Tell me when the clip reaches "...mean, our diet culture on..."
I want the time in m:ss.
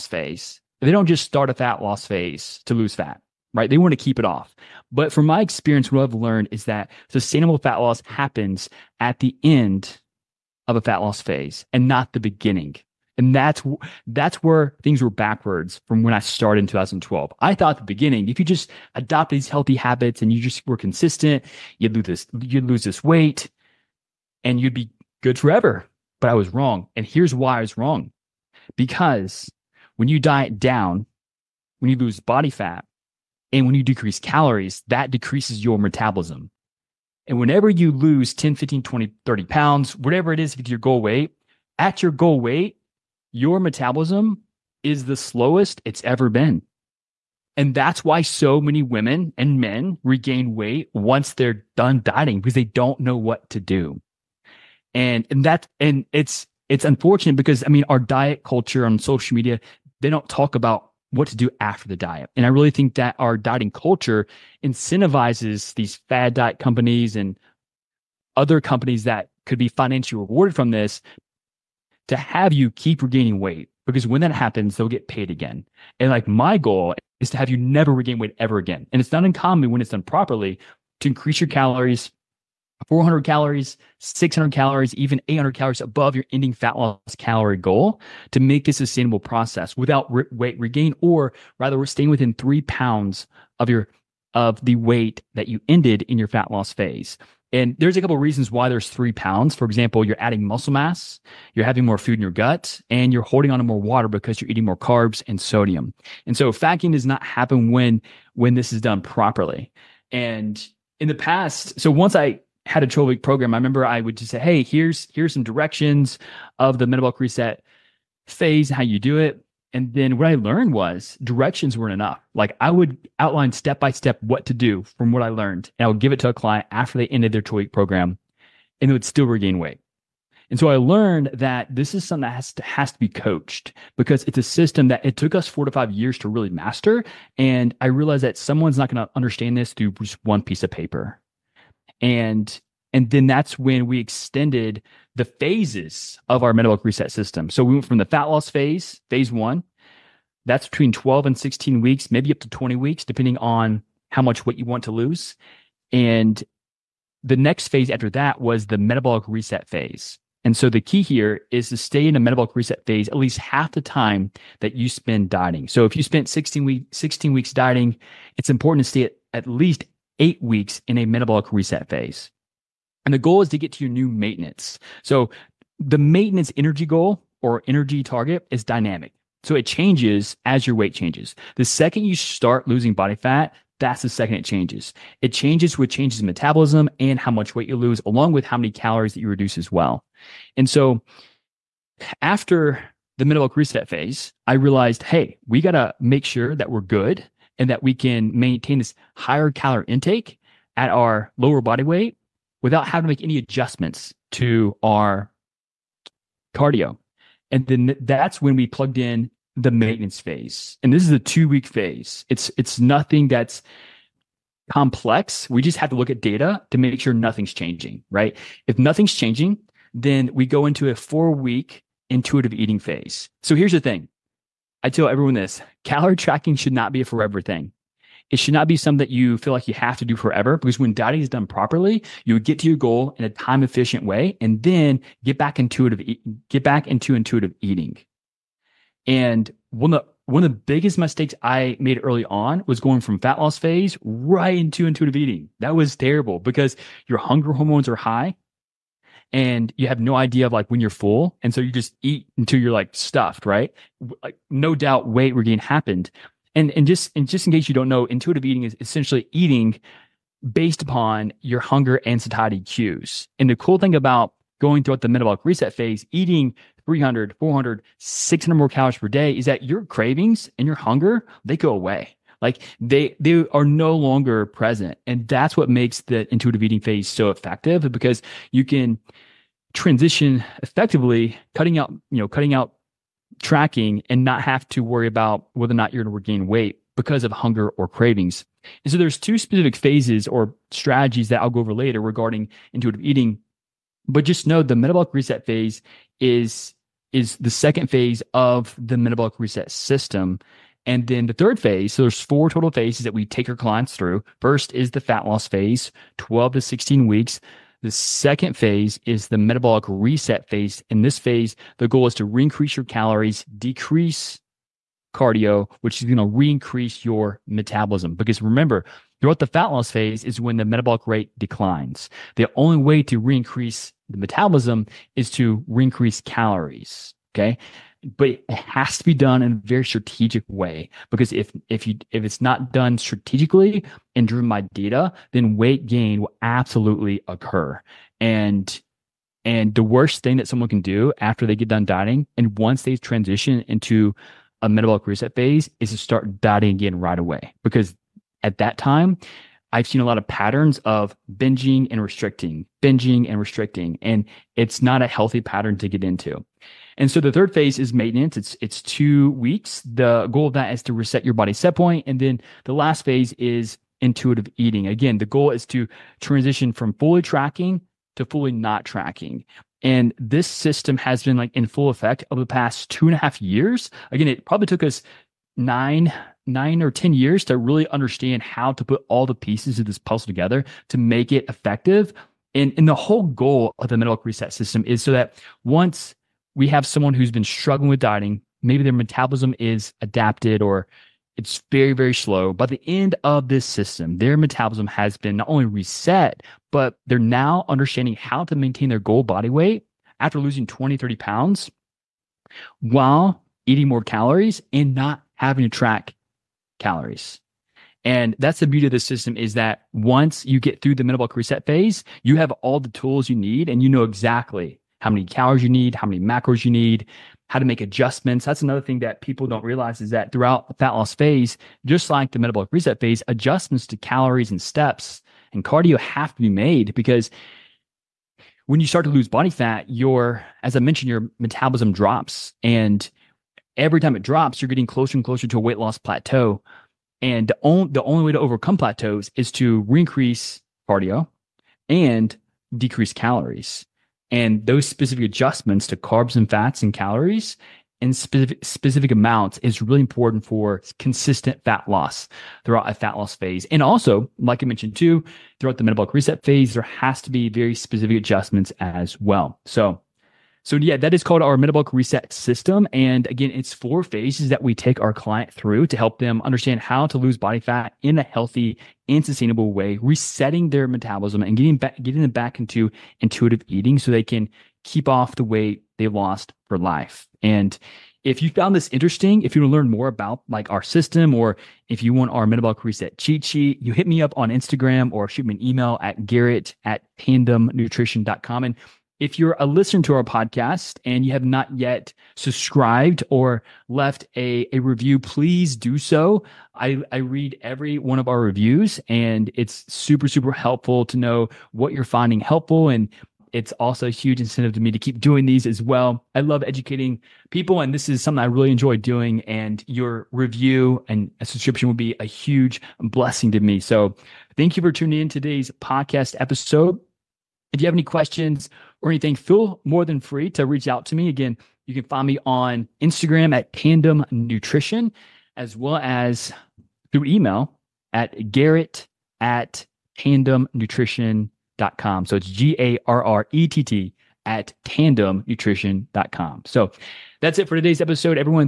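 0:57.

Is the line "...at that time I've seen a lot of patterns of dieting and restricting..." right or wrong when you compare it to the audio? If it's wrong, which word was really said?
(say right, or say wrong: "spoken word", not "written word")
wrong: "binging", not "dieting".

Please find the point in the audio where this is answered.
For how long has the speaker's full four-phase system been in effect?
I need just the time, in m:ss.
6:12.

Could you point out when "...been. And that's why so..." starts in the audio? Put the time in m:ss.
0:46.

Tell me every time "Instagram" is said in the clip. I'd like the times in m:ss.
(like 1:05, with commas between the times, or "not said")
8:04, 8:43.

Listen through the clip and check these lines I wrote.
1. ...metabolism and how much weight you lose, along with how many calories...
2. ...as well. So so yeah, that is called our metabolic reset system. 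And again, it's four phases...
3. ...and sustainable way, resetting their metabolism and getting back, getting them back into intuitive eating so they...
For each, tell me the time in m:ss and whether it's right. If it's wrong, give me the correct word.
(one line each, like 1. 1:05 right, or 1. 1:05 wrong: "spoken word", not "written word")
1. 3:06 right
2. 7:38 right
3. 7:49 right.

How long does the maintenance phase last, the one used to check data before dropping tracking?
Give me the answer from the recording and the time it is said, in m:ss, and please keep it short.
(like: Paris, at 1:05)
2 weeks, at 3:31.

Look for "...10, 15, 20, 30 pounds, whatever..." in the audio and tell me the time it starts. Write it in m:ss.
0:38.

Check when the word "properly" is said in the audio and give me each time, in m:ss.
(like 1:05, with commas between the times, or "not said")
1:20, 1:49, 3:51.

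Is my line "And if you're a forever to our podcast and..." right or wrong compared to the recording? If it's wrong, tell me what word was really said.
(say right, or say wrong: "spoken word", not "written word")
wrong: "listener", not "forever".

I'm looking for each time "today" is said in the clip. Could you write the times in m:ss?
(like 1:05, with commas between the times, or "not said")
8:35, 8:57.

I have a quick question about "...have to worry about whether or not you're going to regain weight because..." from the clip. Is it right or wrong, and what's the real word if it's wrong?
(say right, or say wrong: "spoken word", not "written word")
right.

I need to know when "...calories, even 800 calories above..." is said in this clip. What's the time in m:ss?
1:24.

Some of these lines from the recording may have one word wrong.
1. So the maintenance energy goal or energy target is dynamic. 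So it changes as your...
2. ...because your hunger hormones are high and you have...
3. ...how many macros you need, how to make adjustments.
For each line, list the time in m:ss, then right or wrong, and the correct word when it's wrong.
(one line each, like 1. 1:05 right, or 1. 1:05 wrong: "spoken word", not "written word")
1. 2:55 right
2. 4:06 right
3. 6:55 right.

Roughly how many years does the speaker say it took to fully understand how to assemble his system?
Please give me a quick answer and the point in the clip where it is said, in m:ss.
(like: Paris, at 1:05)
9 or 10, at 6:16.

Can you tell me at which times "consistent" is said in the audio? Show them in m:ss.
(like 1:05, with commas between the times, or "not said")
0:20, 7:30.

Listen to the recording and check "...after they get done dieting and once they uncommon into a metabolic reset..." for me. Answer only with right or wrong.
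wrong.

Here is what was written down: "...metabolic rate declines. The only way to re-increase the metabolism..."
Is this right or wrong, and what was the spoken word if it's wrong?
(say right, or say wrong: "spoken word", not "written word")
right.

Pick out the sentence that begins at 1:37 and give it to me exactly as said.
And there's a couple of reasons why there's three pounds.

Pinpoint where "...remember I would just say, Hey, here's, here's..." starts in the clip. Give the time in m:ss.
1:53.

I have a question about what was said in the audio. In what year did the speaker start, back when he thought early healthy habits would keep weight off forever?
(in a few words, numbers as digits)
2012.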